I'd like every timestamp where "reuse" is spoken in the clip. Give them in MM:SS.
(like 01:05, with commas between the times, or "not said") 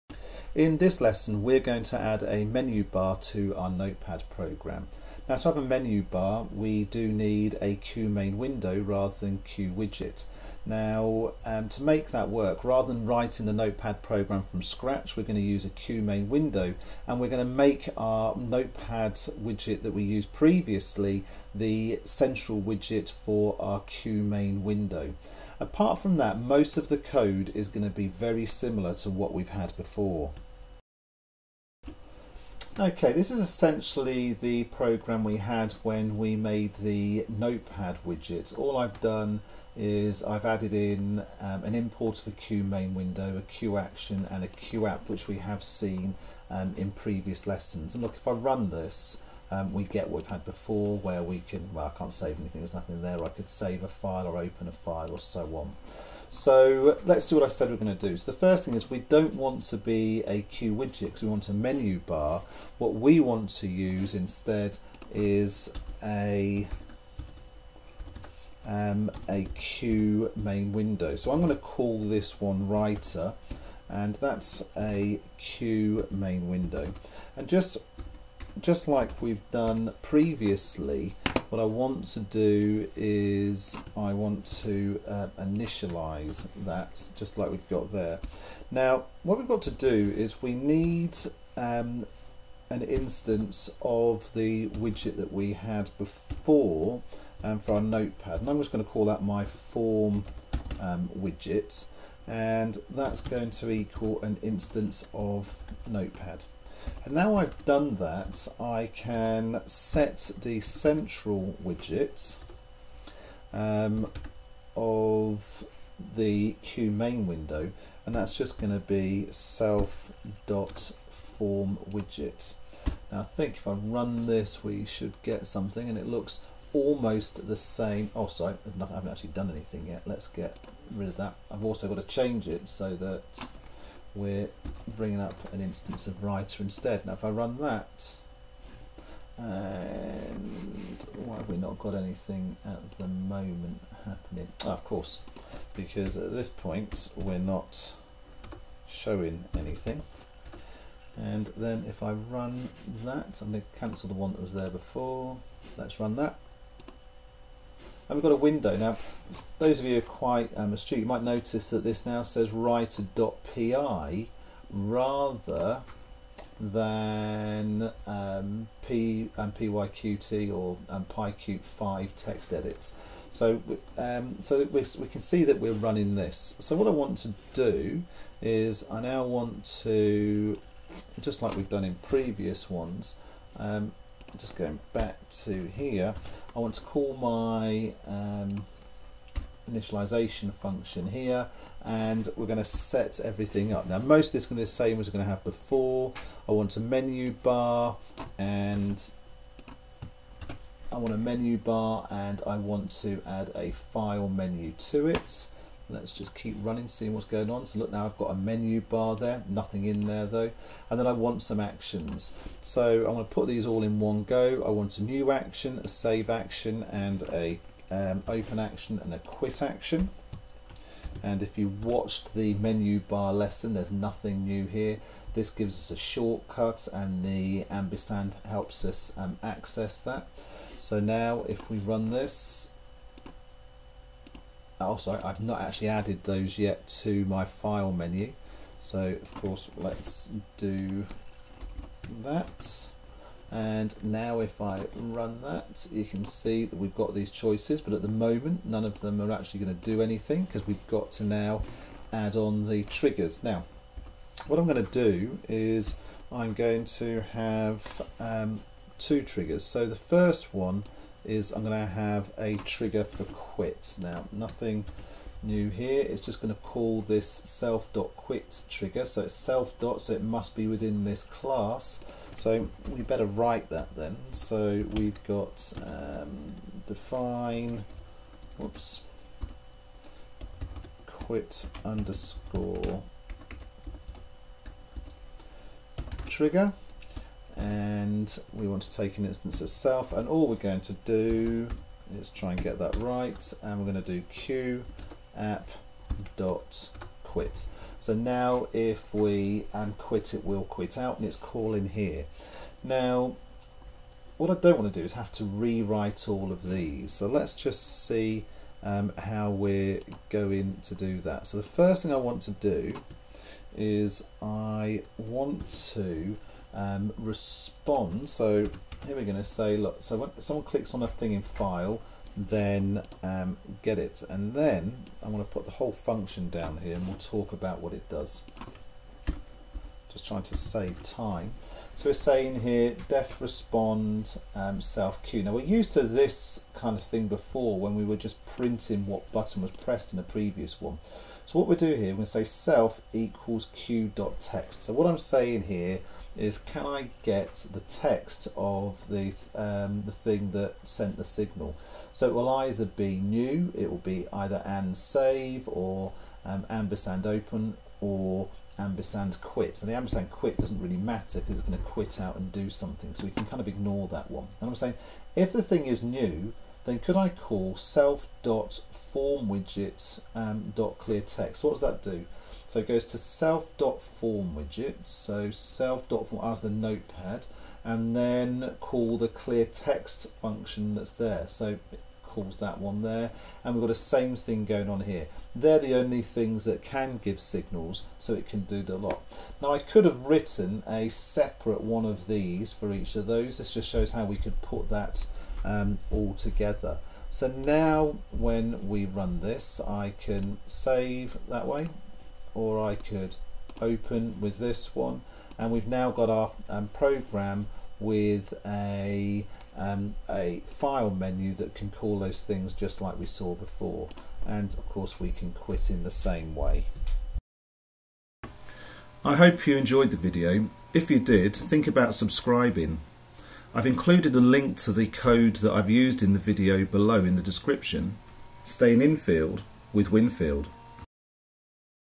not said.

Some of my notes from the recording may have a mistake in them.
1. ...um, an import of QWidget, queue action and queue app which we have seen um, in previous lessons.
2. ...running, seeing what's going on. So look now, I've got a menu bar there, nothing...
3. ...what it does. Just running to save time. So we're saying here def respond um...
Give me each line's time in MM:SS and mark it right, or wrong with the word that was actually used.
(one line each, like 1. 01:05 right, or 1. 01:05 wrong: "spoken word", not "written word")
1. 00:41 wrong: "QMainWindow", not "QWidget"
2. 03:26 right
3. 05:27 wrong: "trying", not "running".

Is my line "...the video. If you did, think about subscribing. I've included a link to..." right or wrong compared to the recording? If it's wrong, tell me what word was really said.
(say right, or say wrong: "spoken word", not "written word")
right.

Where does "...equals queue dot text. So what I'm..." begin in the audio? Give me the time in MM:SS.
05:43.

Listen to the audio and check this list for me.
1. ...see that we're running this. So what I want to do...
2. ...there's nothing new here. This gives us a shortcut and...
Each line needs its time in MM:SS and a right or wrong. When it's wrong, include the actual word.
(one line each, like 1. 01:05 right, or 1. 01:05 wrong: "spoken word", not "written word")
1. 02:55 right
2. 03:43 right.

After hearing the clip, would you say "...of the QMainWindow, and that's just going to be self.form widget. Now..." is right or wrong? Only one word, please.
right.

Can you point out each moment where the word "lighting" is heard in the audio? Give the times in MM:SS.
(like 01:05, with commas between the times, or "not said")
not said.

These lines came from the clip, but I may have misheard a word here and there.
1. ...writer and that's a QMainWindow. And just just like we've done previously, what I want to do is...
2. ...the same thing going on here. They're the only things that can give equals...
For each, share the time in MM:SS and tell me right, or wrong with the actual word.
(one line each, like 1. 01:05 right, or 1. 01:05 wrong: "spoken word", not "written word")
1. 01:12 right
2. 06:23 wrong: "signals", not "equals".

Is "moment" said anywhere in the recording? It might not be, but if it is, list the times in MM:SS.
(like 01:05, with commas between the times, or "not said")
02:23, 04:08.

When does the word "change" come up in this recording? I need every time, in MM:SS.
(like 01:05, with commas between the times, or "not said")
02:12.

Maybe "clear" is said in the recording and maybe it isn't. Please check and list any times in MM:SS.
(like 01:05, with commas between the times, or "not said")
06:10, 06:19.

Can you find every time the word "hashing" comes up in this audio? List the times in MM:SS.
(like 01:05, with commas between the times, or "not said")
not said.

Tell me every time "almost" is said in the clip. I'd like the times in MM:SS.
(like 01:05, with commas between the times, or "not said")
02:06.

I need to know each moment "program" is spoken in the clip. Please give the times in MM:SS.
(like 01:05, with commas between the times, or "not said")
00:04, 00:14, 00:34, 06:46.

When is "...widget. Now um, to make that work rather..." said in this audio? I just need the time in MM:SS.
00:09.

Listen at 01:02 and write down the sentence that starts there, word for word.
What we want to use instead is a um, a QMainWindow.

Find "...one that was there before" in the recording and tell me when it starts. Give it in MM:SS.
02:34.